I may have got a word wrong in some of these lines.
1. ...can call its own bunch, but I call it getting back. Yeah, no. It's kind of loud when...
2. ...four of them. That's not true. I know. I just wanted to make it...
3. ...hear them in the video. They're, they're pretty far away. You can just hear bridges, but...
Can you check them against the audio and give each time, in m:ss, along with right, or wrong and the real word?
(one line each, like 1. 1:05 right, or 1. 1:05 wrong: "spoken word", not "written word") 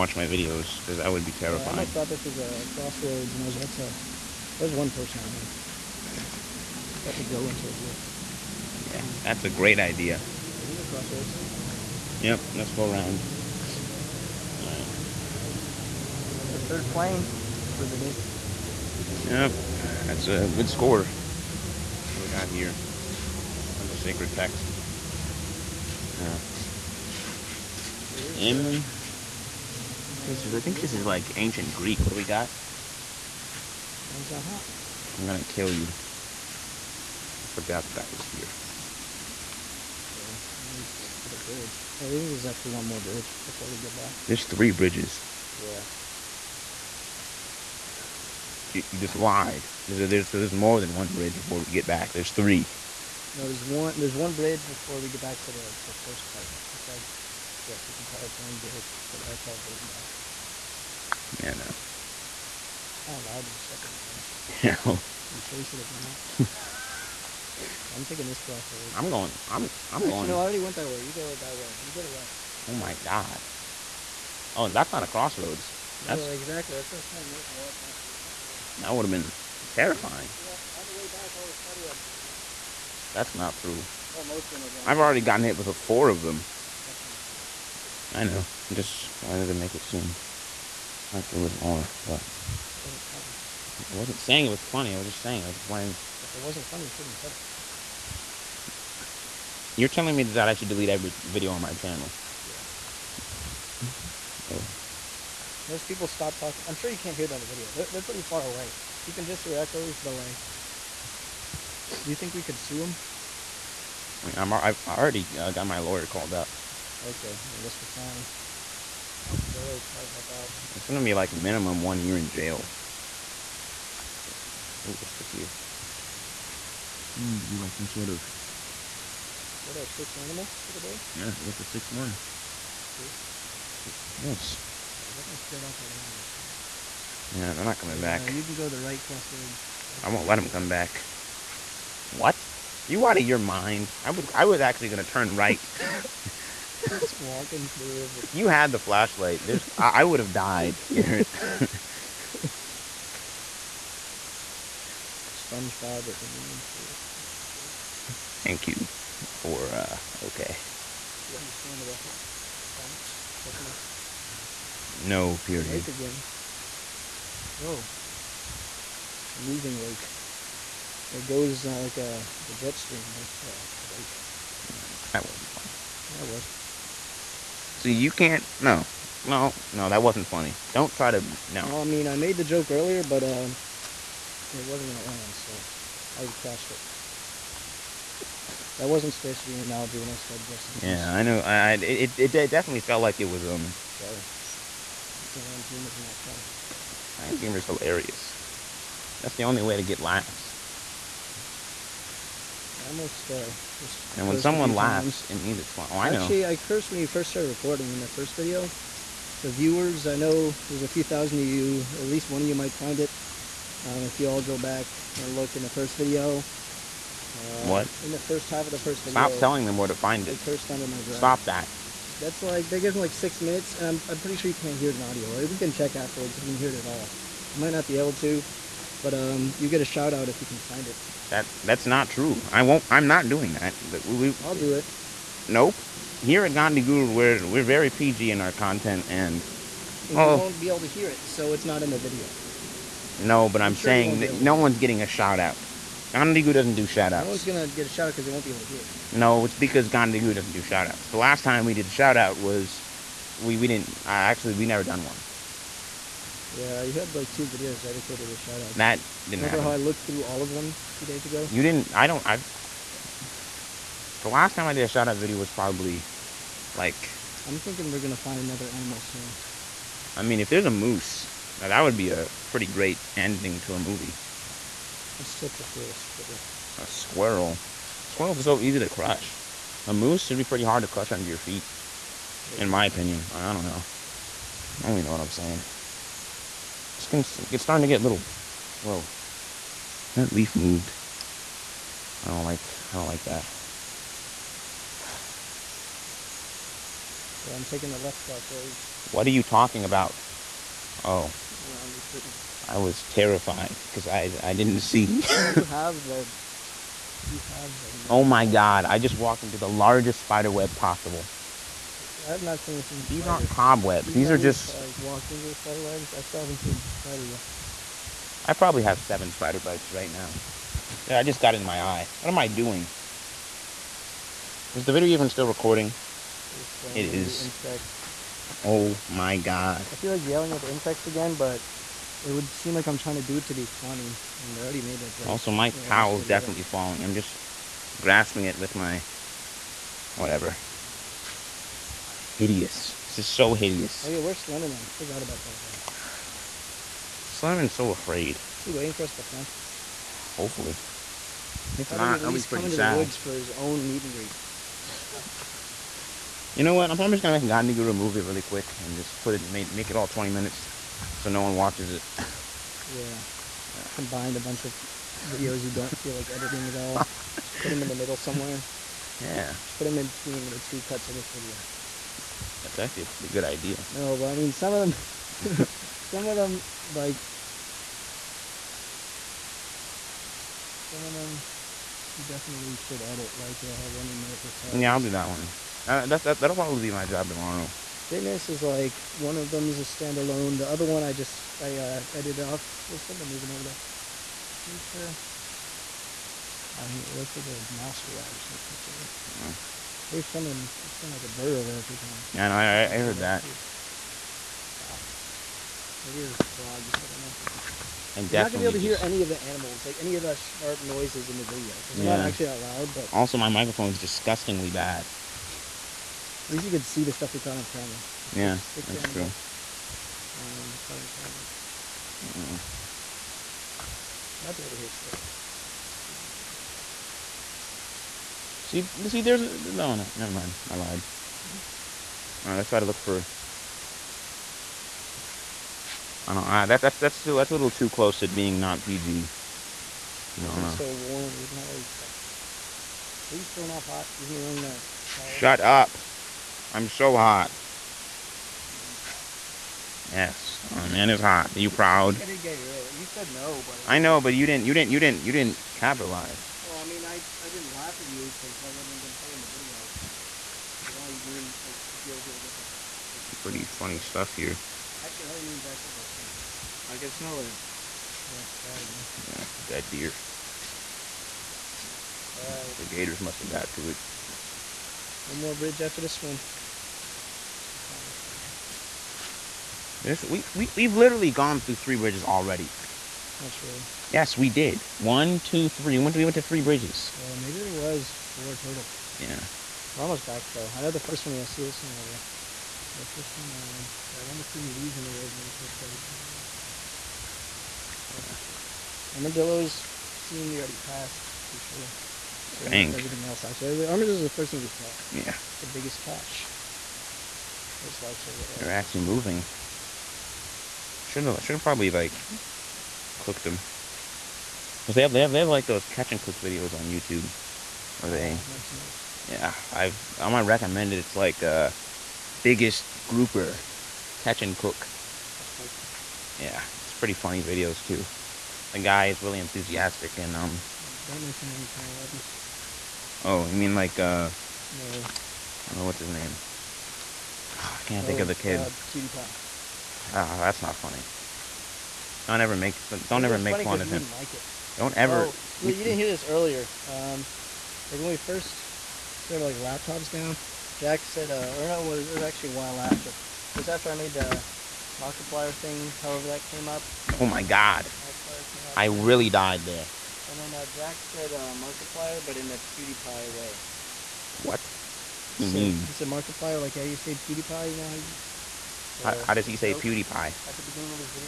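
1. 0:57 wrong: "bitch", not "bunch"
2. 1:25 right
3. 1:47 wrong: "echoes", not "bridges".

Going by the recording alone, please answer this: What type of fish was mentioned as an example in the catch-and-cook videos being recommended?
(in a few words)
Grouper.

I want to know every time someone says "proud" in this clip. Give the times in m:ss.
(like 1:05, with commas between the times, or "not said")
7:31.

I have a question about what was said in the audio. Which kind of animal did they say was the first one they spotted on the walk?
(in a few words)
Armadillo.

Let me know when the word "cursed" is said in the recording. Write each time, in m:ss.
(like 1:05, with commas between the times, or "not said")
3:26, 3:40.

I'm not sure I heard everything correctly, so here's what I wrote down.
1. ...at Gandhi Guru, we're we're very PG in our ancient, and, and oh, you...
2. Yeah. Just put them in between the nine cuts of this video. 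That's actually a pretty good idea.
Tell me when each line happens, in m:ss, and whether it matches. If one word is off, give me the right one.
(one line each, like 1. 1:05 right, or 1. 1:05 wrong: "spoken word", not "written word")
1. 3:56 wrong: "content", not "ancient"
2. 6:09 wrong: "two", not "nine".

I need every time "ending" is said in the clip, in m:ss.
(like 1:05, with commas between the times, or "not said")
4:33.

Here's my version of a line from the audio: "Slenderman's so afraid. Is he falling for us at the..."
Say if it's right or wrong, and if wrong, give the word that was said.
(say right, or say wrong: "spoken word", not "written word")
wrong: "waiting", not "falling".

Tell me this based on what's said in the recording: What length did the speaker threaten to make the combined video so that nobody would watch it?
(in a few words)
20 minutes.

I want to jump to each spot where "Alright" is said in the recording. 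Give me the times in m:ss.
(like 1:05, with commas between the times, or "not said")
0:14, 7:52.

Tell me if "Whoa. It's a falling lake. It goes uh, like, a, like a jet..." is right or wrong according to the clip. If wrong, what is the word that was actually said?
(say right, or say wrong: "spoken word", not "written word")
wrong: "moving", not "falling".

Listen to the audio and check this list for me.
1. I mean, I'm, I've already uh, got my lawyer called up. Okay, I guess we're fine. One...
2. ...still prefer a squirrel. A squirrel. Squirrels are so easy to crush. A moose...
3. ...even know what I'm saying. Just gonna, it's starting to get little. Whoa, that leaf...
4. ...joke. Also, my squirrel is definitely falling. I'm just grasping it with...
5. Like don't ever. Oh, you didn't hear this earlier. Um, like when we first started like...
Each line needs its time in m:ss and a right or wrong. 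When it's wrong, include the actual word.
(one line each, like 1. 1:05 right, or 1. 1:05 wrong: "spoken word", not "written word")
1. 1:54 right
2. 4:35 right
3. 4:44 right
4. 5:35 wrong: "towel", not "squirrel"
5. 9:04 right.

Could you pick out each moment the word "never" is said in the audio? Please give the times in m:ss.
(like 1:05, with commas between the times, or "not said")
4:14, 7:10, 8:38.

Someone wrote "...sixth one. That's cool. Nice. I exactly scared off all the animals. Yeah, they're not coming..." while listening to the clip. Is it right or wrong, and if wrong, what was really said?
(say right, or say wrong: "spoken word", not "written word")
wrong: "definitely", not "exactly".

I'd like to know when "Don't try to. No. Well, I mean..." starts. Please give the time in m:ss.
3:00.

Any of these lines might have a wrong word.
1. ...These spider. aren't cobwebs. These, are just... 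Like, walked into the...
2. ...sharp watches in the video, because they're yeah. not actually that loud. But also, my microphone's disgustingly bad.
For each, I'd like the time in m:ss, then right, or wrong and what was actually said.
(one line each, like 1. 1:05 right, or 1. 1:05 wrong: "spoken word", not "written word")
1. 5:13 right
2. 6:50 wrong: "noises", not "watches".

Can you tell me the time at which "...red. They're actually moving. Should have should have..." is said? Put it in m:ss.
8:28.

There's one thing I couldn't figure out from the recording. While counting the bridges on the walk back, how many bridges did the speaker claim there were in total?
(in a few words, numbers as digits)
3.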